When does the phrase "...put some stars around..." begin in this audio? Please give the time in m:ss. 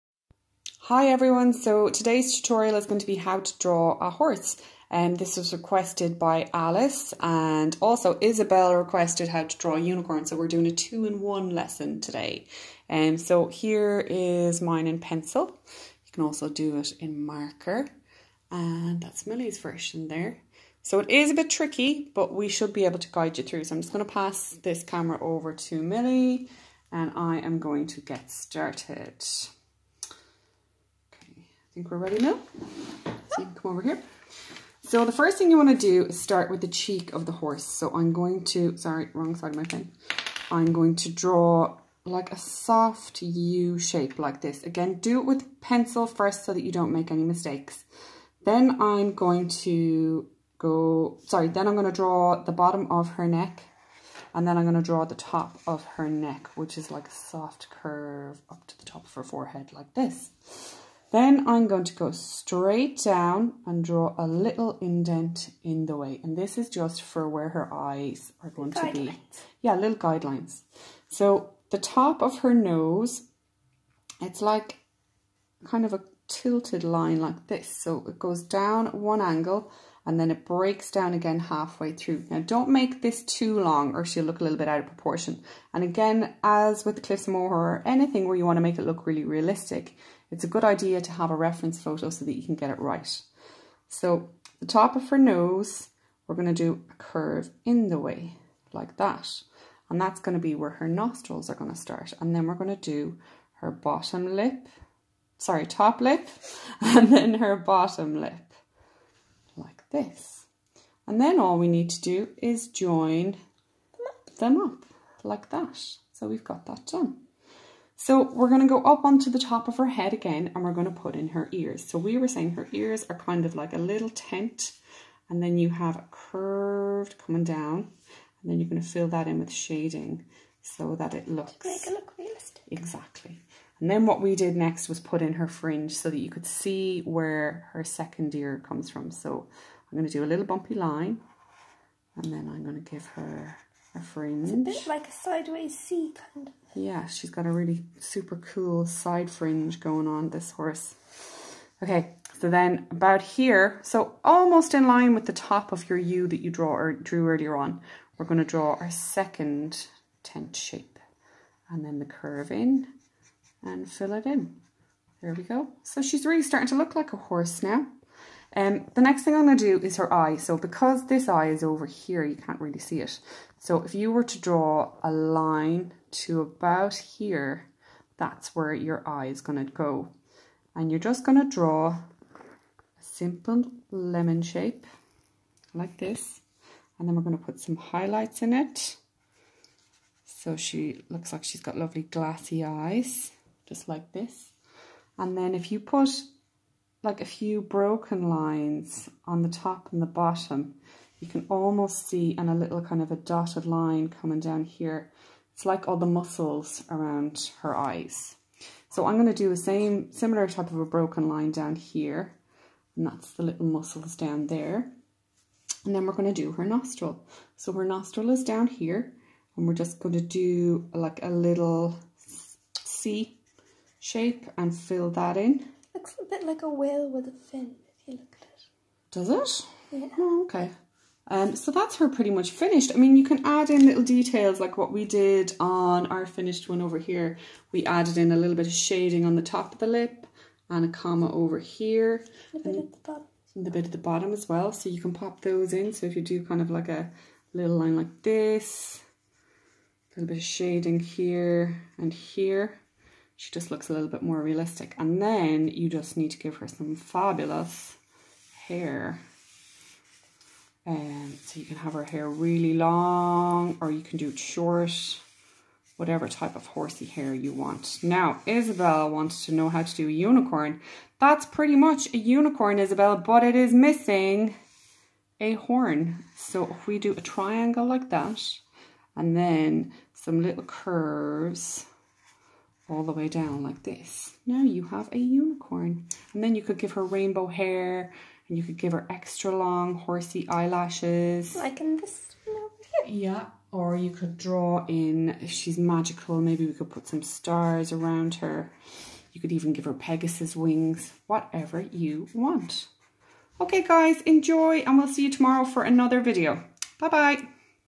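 4:56.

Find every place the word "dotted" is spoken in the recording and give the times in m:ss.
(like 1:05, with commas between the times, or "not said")
3:23.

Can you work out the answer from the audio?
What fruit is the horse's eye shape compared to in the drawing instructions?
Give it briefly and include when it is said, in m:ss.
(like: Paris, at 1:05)
Lemon, at 3:03.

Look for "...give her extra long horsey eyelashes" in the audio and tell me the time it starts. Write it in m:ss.
4:48.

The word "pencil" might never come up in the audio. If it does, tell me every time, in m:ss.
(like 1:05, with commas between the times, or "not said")
0:14, 0:45.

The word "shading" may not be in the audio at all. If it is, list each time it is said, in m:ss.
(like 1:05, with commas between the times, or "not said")
2:09, 3:58, 4:10.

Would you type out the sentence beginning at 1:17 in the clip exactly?
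So it goes down one angle and then it breaks down again halfway through.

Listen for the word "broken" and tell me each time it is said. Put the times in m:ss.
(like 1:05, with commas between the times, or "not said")
3:17, 3:30.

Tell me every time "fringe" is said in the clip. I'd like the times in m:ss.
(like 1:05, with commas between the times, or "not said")
2:15, 2:24, 2:29.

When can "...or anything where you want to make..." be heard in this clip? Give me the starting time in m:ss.
1:27.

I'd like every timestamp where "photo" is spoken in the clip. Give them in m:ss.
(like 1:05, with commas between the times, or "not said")
1:31.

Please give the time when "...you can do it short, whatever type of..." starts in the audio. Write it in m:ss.
4:23.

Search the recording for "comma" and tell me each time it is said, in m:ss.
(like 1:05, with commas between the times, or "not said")
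4:00.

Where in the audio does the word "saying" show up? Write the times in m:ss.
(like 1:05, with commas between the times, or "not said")
2:02.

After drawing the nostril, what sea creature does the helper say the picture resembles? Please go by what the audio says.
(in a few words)
A whale.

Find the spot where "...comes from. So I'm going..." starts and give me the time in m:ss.
2:18.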